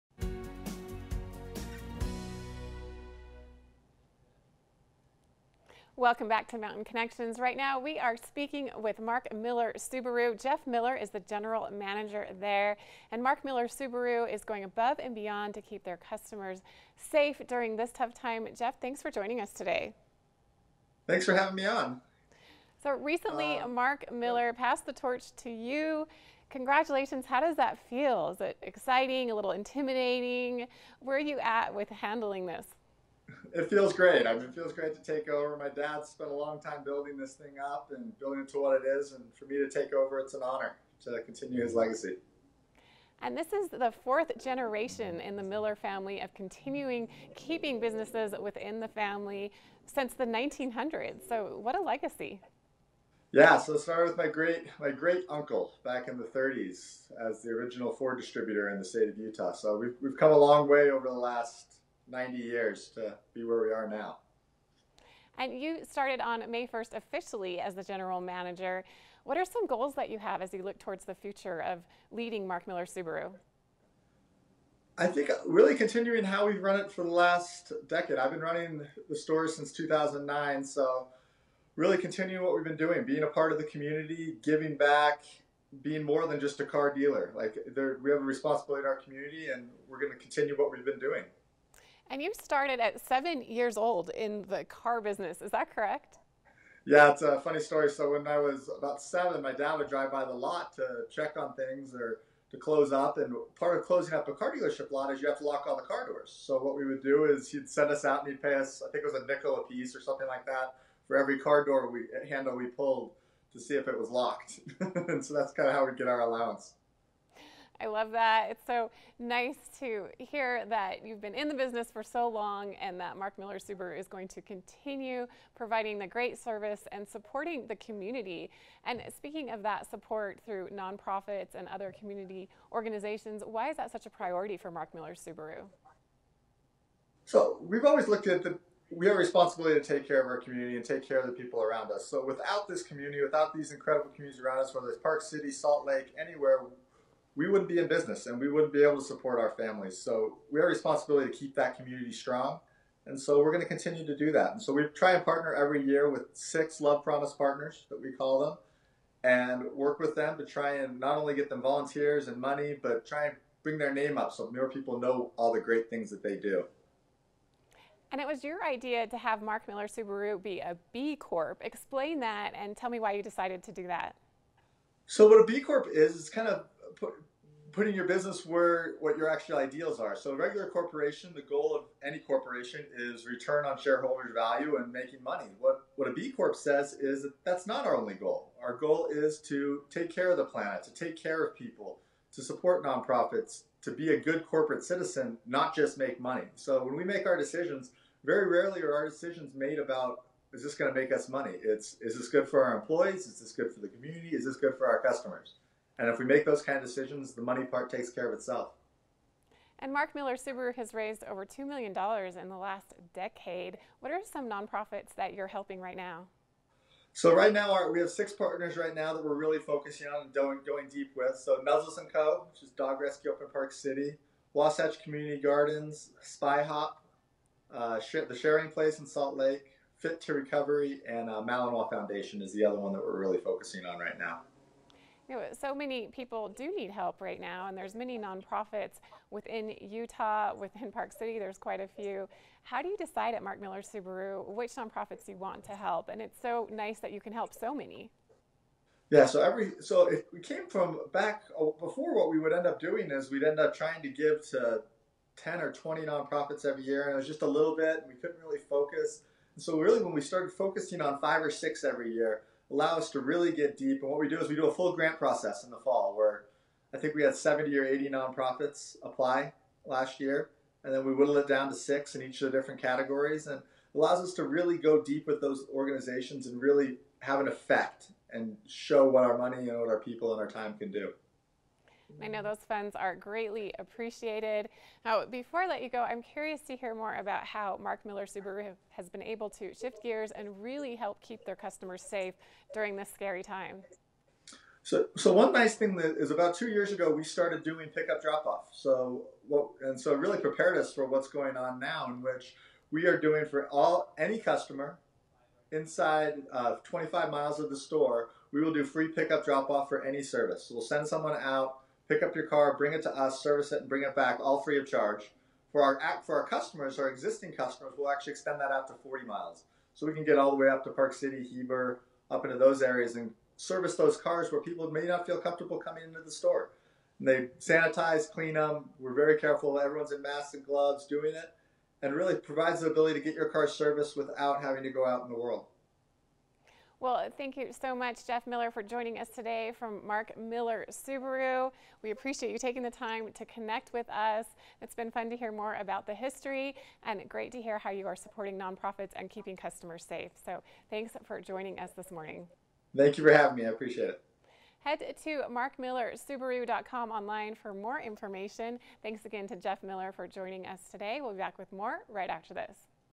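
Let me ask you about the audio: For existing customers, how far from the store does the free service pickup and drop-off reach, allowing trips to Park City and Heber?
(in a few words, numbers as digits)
40 miles.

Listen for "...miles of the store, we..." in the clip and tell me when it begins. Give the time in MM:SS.
05:07.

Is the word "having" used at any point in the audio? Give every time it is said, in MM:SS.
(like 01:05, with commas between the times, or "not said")
00:21, 05:34, 05:53.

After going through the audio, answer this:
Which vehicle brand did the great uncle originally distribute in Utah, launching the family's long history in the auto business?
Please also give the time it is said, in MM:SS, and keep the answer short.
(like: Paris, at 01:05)
Ford, at 00:57.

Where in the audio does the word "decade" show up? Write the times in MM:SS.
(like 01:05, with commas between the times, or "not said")
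01:17, 03:33.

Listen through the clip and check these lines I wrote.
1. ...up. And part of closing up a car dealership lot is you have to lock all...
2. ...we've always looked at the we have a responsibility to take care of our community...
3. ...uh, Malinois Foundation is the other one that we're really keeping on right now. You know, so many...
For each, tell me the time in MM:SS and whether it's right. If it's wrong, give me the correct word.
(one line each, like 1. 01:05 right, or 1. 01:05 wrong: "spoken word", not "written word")
1. 01:42 right
2. 02:17 right
3. 03:51 wrong: "focusing", not "keeping".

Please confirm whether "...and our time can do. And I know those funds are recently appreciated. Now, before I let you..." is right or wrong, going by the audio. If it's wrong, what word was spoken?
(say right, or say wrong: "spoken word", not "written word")
wrong: "greatly", not "recently".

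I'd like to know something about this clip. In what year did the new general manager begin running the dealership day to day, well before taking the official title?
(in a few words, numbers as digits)
2009.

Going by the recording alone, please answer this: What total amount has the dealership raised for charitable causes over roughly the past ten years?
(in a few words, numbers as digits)
$2 million.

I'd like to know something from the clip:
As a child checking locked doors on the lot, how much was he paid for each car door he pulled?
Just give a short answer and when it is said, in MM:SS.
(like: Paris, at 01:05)
A nickel, at 01:49.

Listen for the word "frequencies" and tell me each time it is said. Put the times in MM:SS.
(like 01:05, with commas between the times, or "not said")
not said.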